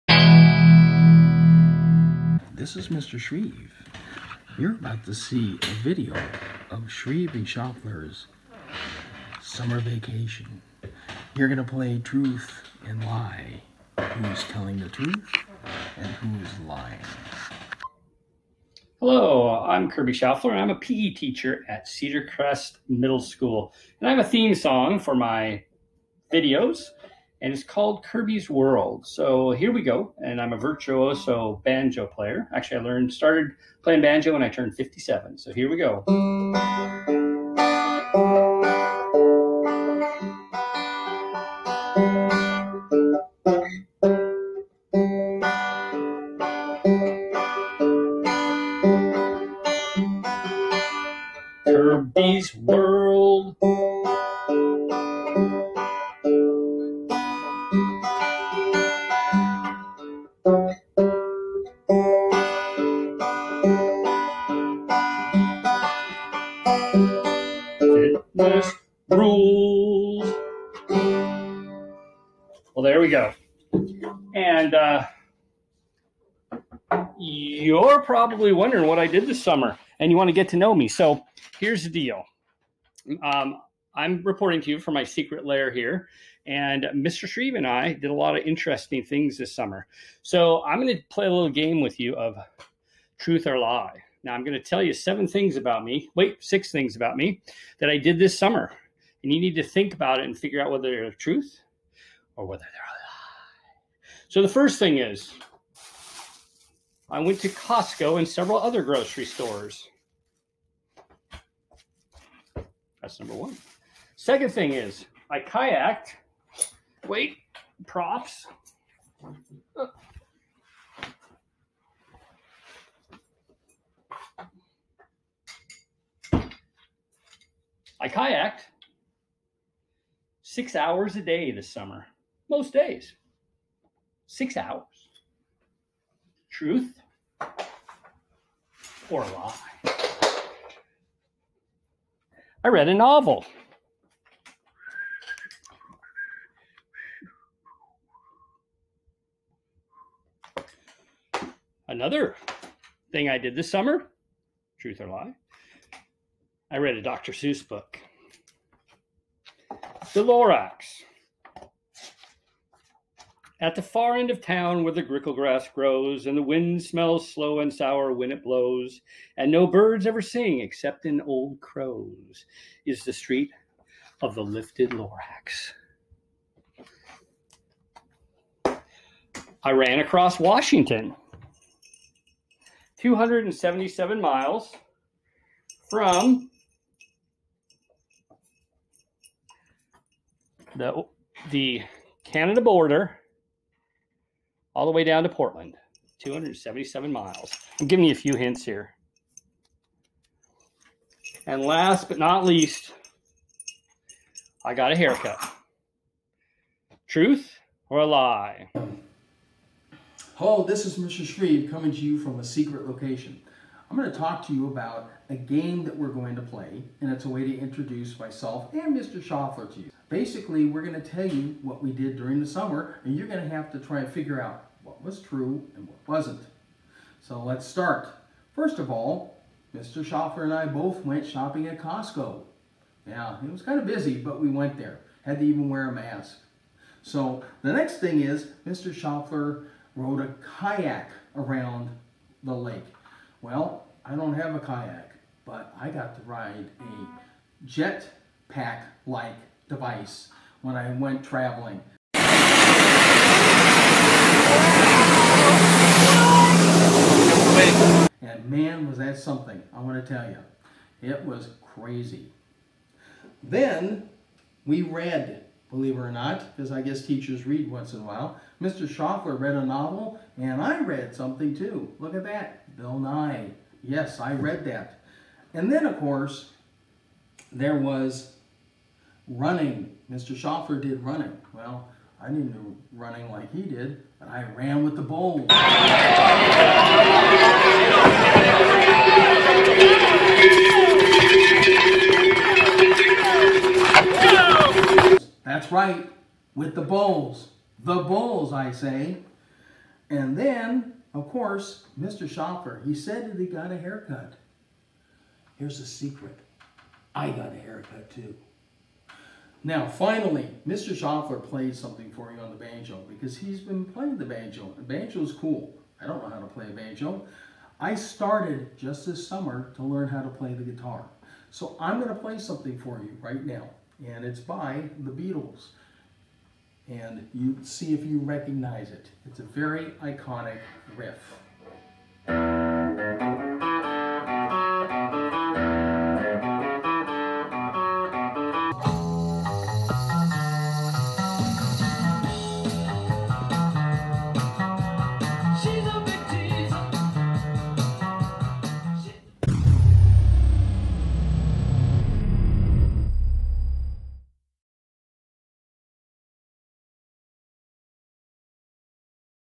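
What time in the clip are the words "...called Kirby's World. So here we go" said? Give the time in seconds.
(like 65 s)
27 s.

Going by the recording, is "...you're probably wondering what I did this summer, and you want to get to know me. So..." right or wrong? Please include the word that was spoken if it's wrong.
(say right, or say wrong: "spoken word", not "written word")
right.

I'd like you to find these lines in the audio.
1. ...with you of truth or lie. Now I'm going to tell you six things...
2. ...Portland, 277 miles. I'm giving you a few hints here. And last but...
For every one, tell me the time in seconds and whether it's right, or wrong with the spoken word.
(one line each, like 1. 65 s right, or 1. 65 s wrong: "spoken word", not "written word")
1. 91 s wrong: "seven", not "six"
2. 195 s right.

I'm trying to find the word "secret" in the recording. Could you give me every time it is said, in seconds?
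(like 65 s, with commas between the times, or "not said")
85 s, 212 s, 305 s.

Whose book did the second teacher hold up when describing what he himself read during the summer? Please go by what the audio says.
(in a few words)
Bill Nye.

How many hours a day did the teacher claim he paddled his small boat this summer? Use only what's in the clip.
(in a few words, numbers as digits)
6.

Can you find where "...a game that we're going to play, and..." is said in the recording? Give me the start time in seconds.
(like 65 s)
215 s.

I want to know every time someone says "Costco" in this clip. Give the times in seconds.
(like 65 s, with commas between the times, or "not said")
107 s, 231 s.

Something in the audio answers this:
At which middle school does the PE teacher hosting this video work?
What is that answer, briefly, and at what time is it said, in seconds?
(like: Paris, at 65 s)
Cedar Crest Middle School, at 21 s.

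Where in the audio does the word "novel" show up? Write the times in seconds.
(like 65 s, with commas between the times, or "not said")
142 s, 269 s.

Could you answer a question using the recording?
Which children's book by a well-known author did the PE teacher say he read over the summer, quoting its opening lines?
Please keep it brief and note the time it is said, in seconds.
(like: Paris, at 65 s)
The Lorax, at 160 s.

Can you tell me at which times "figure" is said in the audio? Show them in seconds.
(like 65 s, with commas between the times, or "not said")
100 s, 224 s.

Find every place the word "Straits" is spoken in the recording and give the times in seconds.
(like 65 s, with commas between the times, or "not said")
not said.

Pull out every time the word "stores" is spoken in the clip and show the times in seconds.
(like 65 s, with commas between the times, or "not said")
109 s.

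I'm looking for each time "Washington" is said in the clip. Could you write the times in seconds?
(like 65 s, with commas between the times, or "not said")
180 s.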